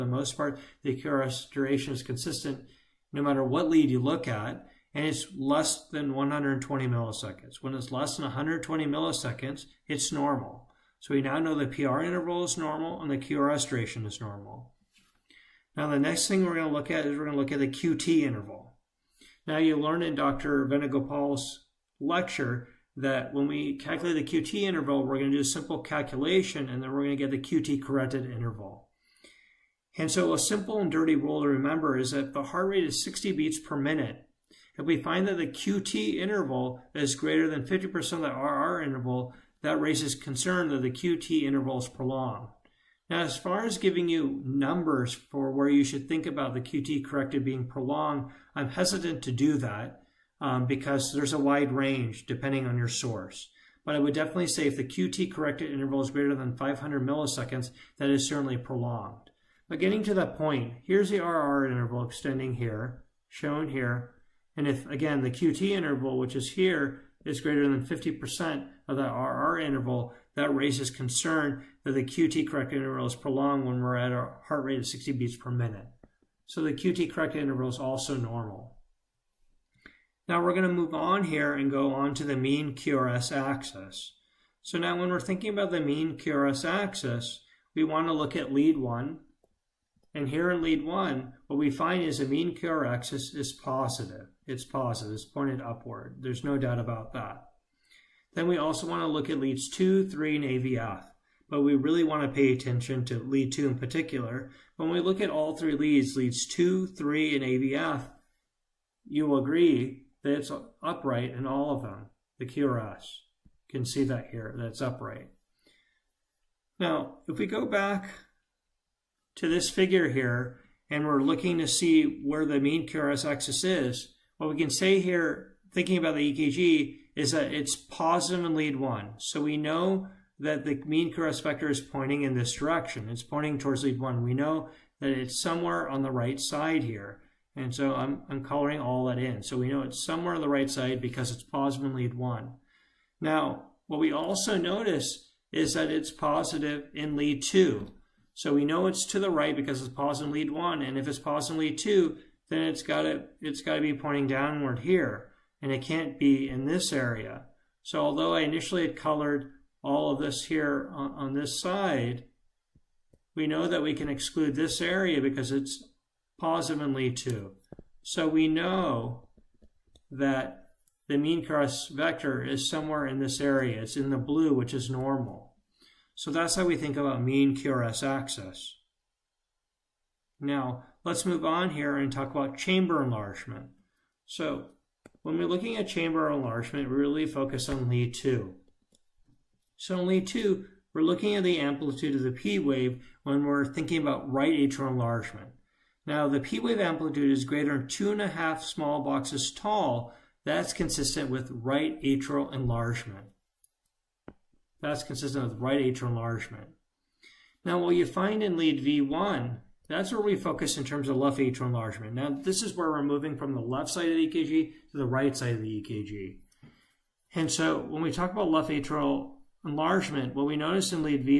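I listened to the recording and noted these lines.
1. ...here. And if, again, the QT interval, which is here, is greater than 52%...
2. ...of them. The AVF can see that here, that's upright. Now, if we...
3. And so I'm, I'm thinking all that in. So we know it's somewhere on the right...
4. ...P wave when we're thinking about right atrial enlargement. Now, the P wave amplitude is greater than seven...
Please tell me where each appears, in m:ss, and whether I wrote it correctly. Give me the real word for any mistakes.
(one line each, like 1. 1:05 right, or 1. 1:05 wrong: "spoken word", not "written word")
1. 1:03 wrong: "50", not "52"
2. 1:51 wrong: "QRS", not "AVF"
3. 2:17 wrong: "coloring", not "thinking"
4. 3:12 wrong: "two", not "seven".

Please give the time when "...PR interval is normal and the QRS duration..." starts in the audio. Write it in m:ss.
0:11.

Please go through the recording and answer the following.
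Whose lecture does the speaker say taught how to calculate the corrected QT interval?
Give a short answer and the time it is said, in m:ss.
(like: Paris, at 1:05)
Dr. Venugopal, at 0:20.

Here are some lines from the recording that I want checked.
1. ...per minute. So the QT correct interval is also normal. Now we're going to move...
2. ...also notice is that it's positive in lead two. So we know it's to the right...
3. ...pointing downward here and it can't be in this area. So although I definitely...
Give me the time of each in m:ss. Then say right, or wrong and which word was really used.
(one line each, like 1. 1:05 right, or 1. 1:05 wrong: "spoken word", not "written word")
1. 1:15 right
2. 2:24 right
3. 2:33 wrong: "initially", not "definitely".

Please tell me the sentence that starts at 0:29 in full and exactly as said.
And so a simple and dirty rule to remember is that the heart rate is 60 beats per minute.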